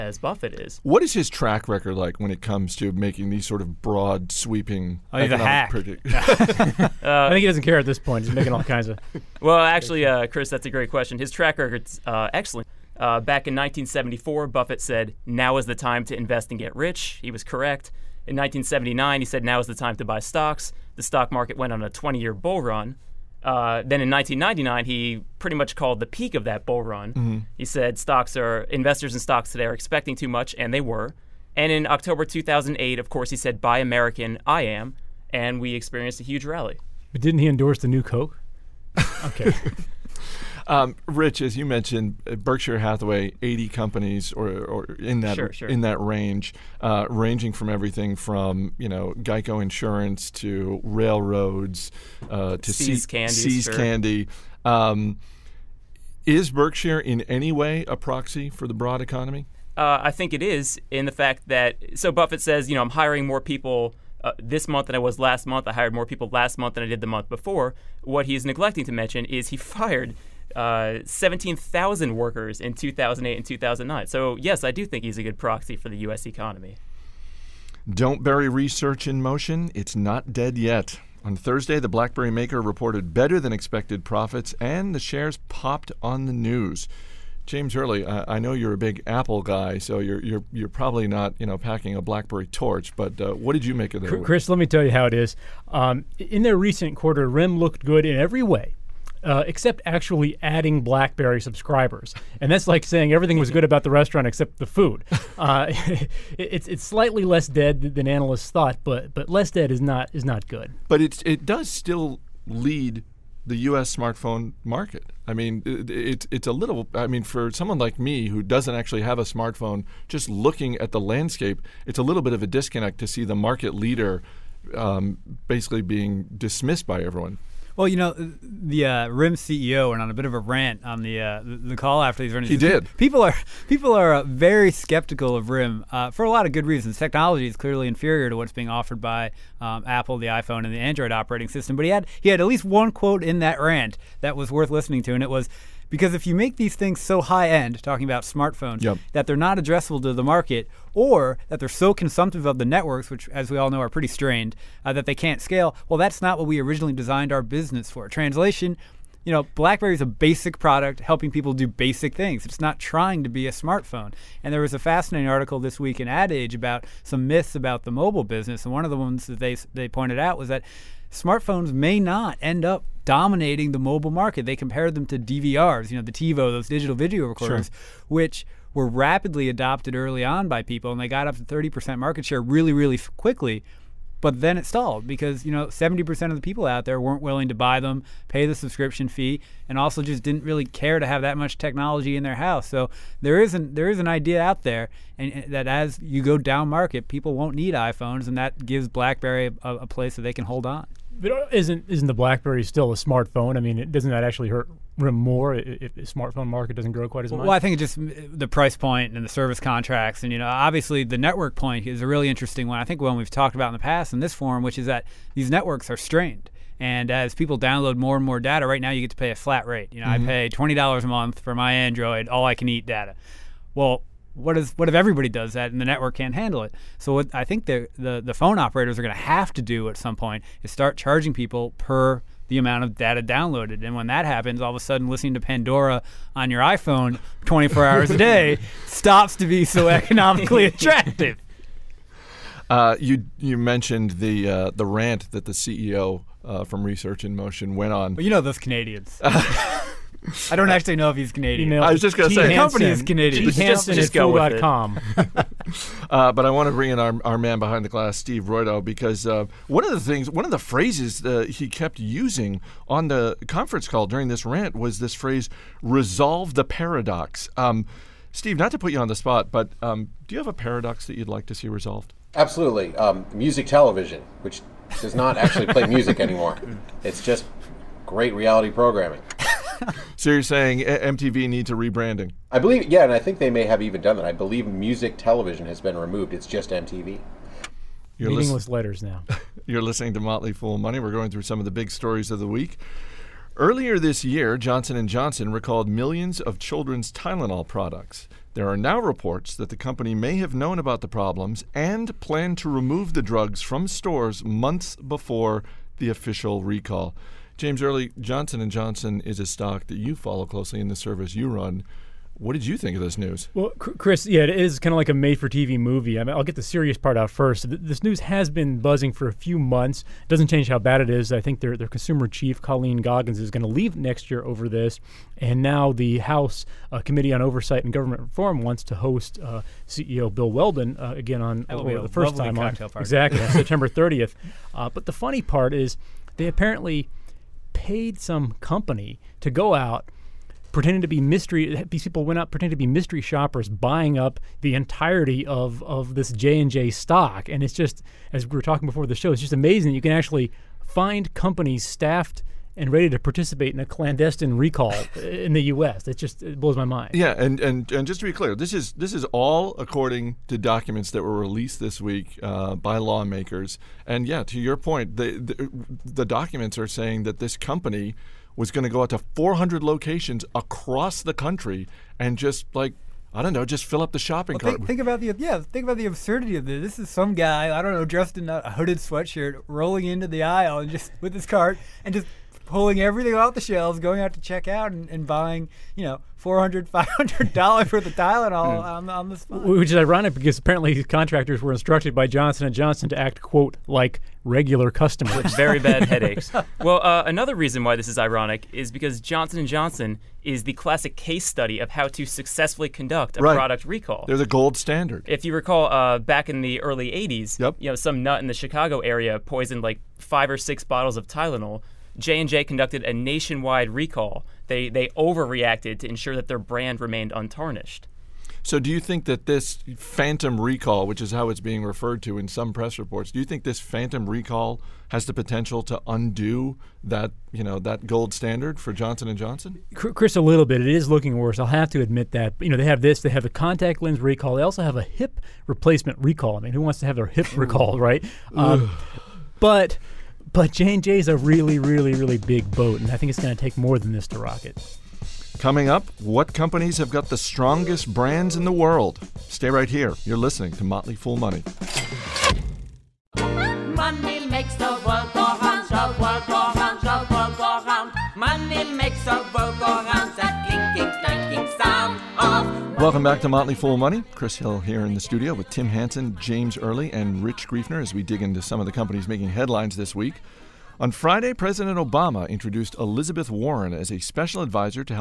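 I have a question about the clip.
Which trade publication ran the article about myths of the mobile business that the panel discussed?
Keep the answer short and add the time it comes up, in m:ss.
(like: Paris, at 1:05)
Ad Age, at 2:46.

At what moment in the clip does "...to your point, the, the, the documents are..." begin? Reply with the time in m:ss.
6:04.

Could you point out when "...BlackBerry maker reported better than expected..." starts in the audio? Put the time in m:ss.
1:21.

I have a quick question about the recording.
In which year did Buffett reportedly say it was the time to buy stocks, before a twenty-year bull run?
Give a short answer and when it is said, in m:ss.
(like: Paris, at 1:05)
1979, at 0:18.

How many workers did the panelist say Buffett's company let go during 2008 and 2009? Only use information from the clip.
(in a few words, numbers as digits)
17,000.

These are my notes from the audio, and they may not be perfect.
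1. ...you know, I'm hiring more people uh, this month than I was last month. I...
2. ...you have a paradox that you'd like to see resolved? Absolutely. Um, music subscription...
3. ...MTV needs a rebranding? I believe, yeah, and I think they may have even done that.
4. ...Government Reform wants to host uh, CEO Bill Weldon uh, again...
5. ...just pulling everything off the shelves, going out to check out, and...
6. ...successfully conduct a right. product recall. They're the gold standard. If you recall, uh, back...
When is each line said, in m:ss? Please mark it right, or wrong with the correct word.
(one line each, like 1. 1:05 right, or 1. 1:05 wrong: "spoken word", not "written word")
1. 1:02 right
2. 4:30 wrong: "television", not "subscription"
3. 4:40 right
4. 5:27 right
5. 6:22 right
6. 6:42 right.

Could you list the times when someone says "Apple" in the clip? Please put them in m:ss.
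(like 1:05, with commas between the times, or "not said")
1:29, 2:19.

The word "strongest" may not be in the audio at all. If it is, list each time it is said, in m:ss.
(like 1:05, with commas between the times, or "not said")
7:27.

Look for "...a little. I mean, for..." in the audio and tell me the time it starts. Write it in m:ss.
1:56.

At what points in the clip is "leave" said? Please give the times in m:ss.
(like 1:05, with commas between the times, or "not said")
5:23.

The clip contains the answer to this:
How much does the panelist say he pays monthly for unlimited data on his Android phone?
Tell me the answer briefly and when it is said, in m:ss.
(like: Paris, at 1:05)
$20, at 3:40.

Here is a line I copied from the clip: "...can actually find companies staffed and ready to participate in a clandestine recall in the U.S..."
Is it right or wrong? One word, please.
right.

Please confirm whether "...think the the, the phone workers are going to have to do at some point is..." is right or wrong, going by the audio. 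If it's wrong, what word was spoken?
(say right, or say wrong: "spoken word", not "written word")
wrong: "operators", not "workers".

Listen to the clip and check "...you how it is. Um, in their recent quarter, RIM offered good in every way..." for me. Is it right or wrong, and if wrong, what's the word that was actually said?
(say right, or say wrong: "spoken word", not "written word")
wrong: "looked", not "offered".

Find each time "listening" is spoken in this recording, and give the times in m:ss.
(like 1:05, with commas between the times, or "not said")
2:24, 3:55, 4:49, 7:30.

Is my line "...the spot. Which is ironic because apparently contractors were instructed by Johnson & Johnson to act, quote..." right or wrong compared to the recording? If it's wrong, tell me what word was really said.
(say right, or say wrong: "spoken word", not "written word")
right.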